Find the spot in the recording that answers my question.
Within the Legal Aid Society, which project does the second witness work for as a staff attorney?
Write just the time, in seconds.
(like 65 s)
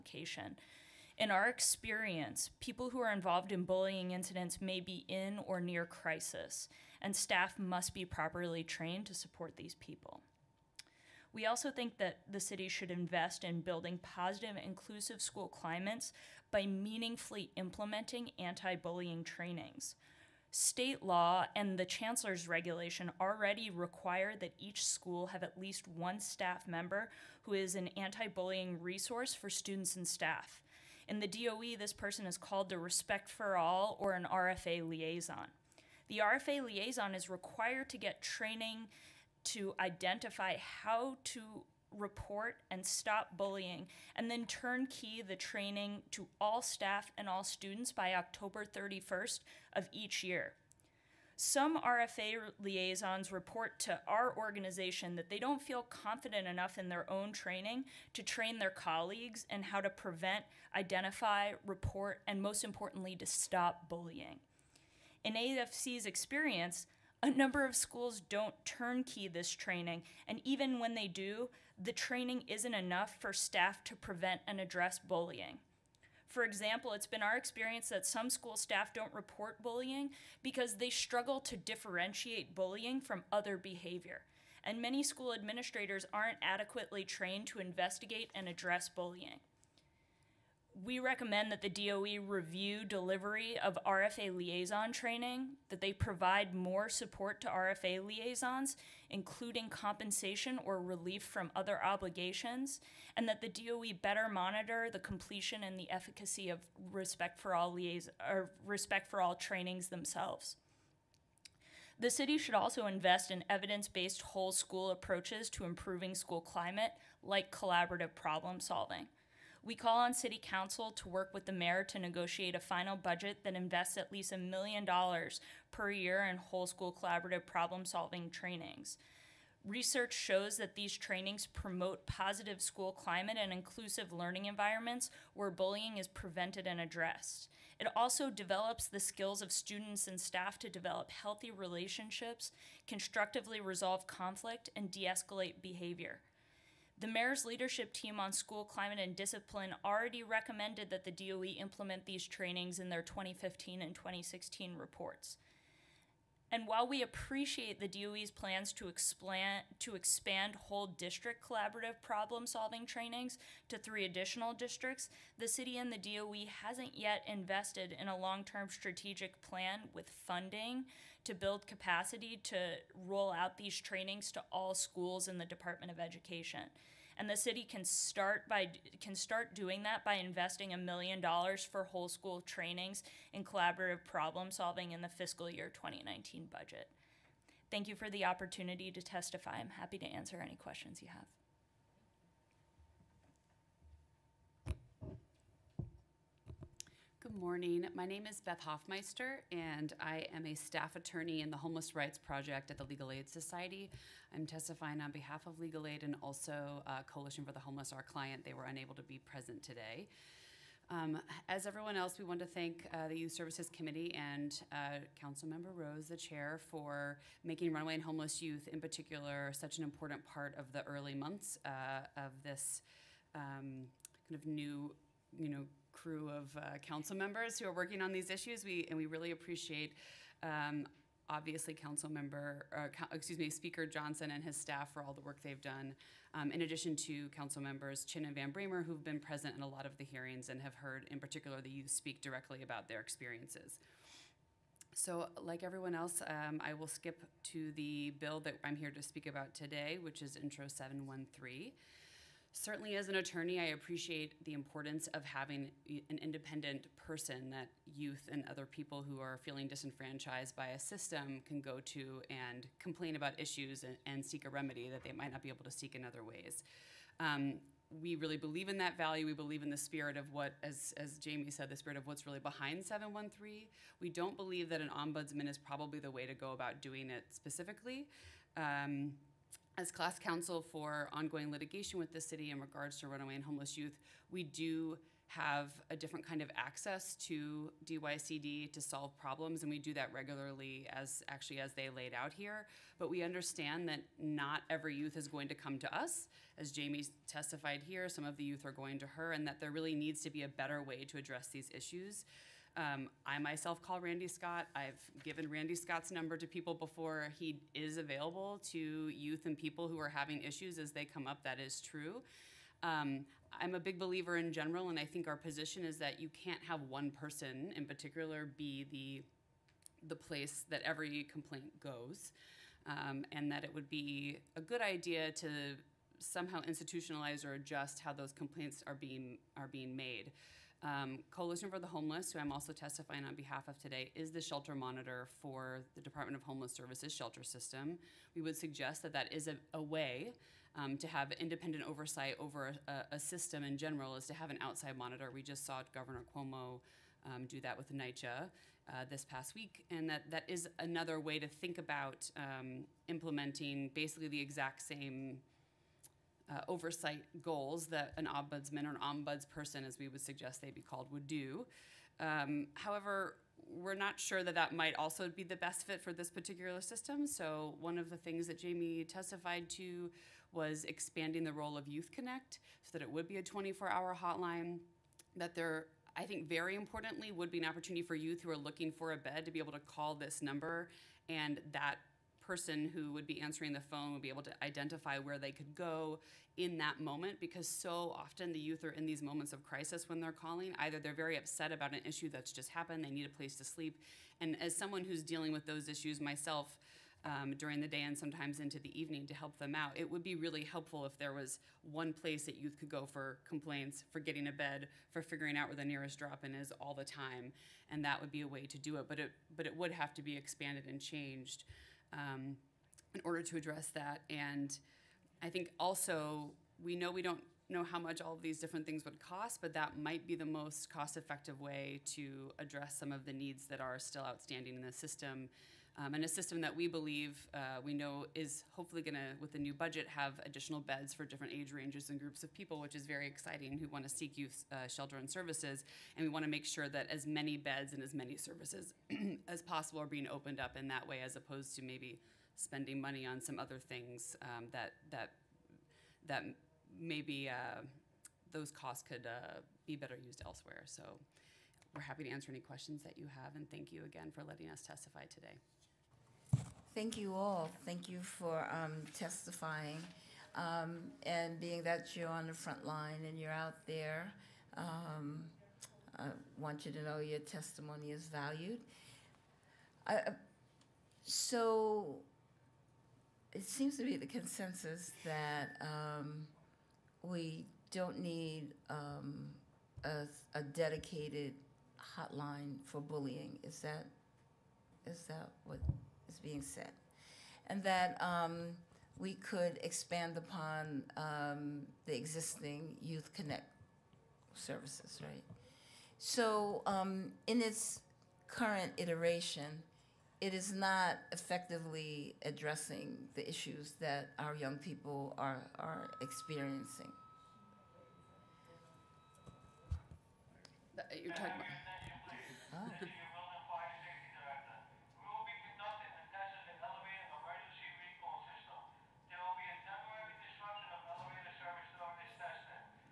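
201 s.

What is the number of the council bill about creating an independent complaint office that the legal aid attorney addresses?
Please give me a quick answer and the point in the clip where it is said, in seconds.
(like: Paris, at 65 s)
Intro 713, at 250 s.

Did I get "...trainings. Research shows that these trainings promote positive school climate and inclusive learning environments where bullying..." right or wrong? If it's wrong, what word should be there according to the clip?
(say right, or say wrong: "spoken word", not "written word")
right.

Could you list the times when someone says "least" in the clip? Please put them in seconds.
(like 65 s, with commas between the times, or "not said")
25 s, 124 s.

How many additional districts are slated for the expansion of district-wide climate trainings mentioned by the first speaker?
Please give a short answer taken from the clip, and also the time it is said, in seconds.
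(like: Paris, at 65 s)
3, at 163 s.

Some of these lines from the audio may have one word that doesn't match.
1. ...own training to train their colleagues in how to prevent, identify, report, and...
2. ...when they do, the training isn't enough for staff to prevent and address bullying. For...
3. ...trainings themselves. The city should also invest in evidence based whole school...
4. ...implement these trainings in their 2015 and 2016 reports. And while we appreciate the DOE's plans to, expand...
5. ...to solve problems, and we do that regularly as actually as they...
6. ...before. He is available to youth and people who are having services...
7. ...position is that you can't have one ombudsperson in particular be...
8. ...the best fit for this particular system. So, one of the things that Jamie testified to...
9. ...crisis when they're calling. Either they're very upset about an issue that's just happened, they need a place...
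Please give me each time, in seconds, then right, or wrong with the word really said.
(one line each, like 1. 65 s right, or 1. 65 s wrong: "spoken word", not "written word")
1. 57 s right
2. 70 s right
3. 109 s right
4. 151 s right
5. 288 s right
6. 306 s wrong: "issues", not "services"
7. 315 s wrong: "person", not "ombudsperson"
8. 365 s right
9. 389 s right.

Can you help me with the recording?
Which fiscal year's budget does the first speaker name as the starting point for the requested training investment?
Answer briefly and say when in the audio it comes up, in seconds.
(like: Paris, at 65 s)
fiscal year 2019, at 185 s.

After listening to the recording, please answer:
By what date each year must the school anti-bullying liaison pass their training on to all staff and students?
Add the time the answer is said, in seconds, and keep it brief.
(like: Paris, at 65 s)
October 31st, at 48 s.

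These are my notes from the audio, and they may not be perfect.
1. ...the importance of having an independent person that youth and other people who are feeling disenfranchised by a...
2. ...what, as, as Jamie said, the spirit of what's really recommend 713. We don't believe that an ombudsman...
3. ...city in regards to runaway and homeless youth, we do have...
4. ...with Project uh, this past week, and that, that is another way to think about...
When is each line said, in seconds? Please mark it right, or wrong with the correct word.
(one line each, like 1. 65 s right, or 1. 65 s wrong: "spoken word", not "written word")
1. 254 s right
2. 270 s wrong: "behind", not "recommend"
3. 282 s right
4. 347 s wrong: "NYCHA", not "Project".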